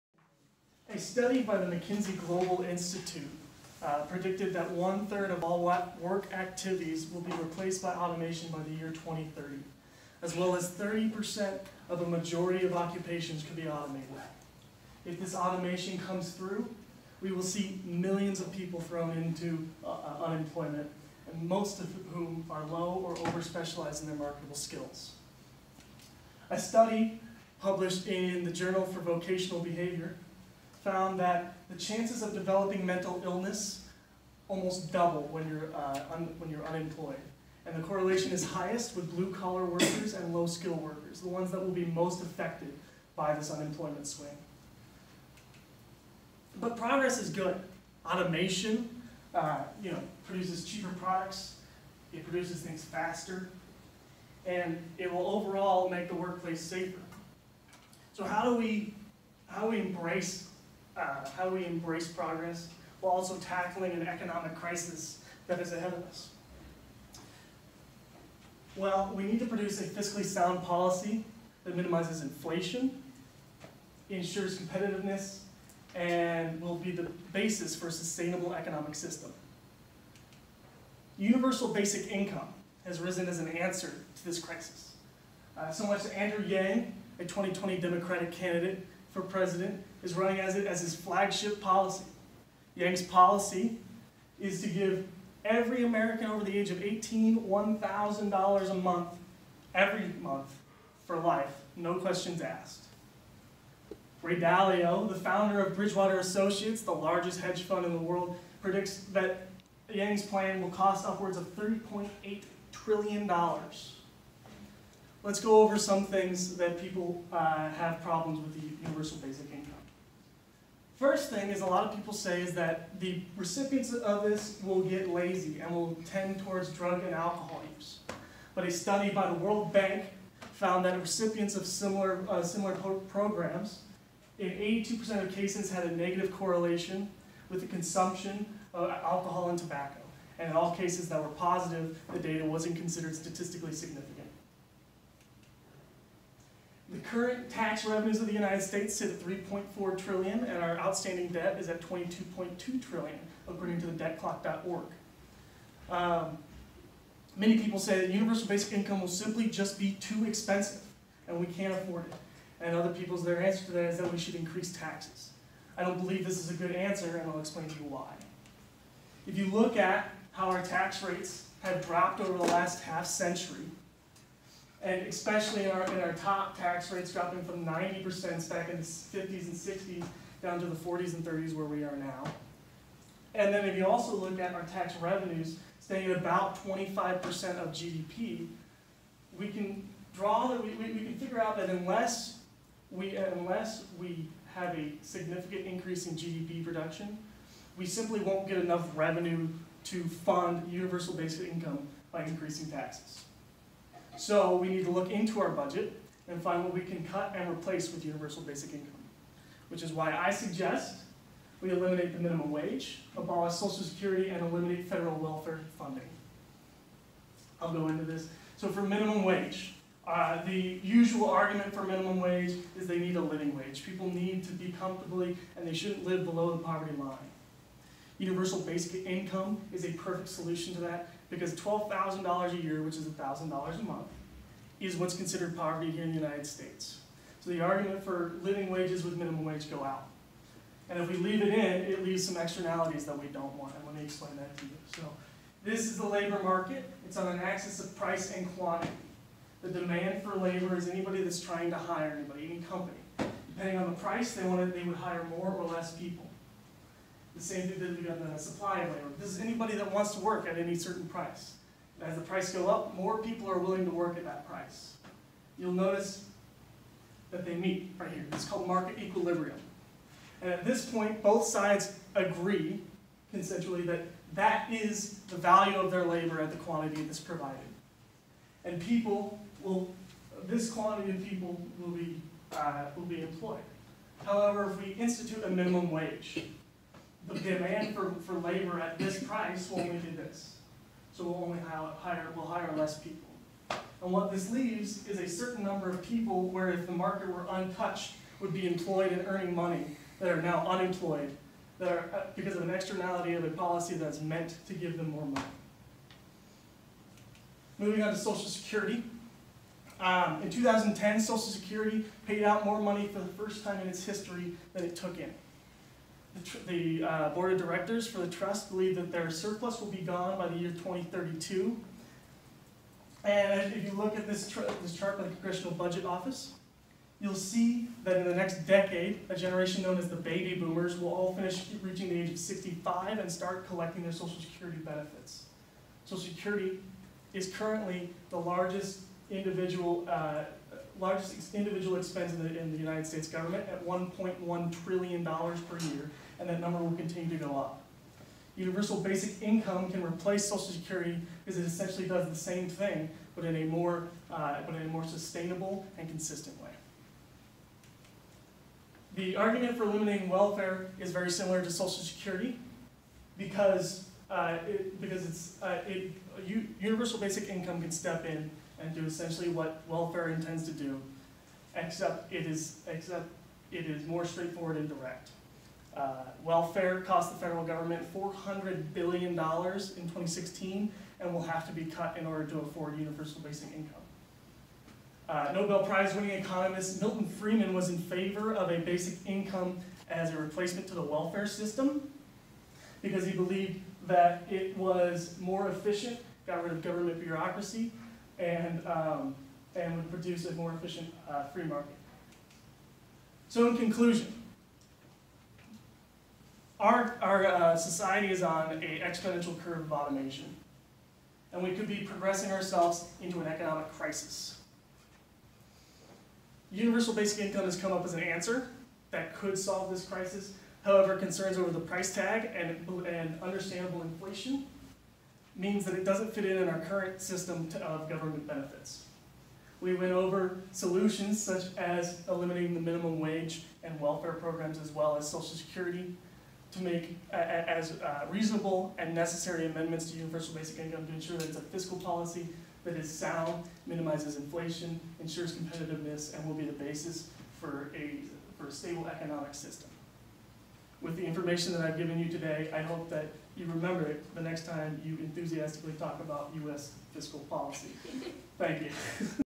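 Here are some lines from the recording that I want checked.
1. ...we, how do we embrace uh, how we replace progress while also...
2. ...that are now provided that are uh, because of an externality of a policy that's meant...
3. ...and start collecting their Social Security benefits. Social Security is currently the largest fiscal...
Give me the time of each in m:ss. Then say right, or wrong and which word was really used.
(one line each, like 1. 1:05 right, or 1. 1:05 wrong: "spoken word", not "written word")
1. 0:58 wrong: "embrace", not "replace"
2. 5:00 wrong: "unemployed", not "provided"
3. 5:33 wrong: "individual", not "fiscal".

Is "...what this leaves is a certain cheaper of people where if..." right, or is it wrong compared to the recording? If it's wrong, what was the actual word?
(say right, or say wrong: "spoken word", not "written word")
wrong: "number", not "cheaper".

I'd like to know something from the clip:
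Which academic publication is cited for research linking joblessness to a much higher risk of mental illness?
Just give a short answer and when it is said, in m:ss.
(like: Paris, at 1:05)
Journal for Vocational Behavior, at 0:28.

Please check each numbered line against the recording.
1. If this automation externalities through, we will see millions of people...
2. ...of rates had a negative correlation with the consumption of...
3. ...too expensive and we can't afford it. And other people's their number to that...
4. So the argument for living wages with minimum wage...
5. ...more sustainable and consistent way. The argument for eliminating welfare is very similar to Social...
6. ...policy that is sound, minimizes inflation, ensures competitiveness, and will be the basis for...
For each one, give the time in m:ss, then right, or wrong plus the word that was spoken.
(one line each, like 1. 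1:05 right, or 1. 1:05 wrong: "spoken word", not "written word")
1. 0:15 wrong: "comes", not "externalities"
2. 2:15 wrong: "cases", not "rates"
3. 2:39 wrong: "answer", not "number"
4. 3:57 right
5. 5:54 right
6. 7:21 right.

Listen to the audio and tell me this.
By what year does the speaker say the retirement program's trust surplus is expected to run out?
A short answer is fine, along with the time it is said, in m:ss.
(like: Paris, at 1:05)
2032, at 5:20.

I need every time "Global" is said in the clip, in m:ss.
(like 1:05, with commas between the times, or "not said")
0:02.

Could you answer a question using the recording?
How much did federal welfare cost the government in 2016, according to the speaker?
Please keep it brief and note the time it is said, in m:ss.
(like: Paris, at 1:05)
$400 billion, at 6:18.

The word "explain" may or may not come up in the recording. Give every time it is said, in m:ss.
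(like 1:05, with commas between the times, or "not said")
2:47, 4:04.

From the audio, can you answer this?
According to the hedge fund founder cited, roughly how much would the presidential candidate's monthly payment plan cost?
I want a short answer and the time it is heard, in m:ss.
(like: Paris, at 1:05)
$3.8 trillion, at 1:51.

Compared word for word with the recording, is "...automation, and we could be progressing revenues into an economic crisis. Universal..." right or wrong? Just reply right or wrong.
wrong.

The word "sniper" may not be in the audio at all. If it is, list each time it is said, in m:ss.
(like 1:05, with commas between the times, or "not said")
not said.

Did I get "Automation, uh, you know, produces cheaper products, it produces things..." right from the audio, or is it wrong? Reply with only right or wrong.
right.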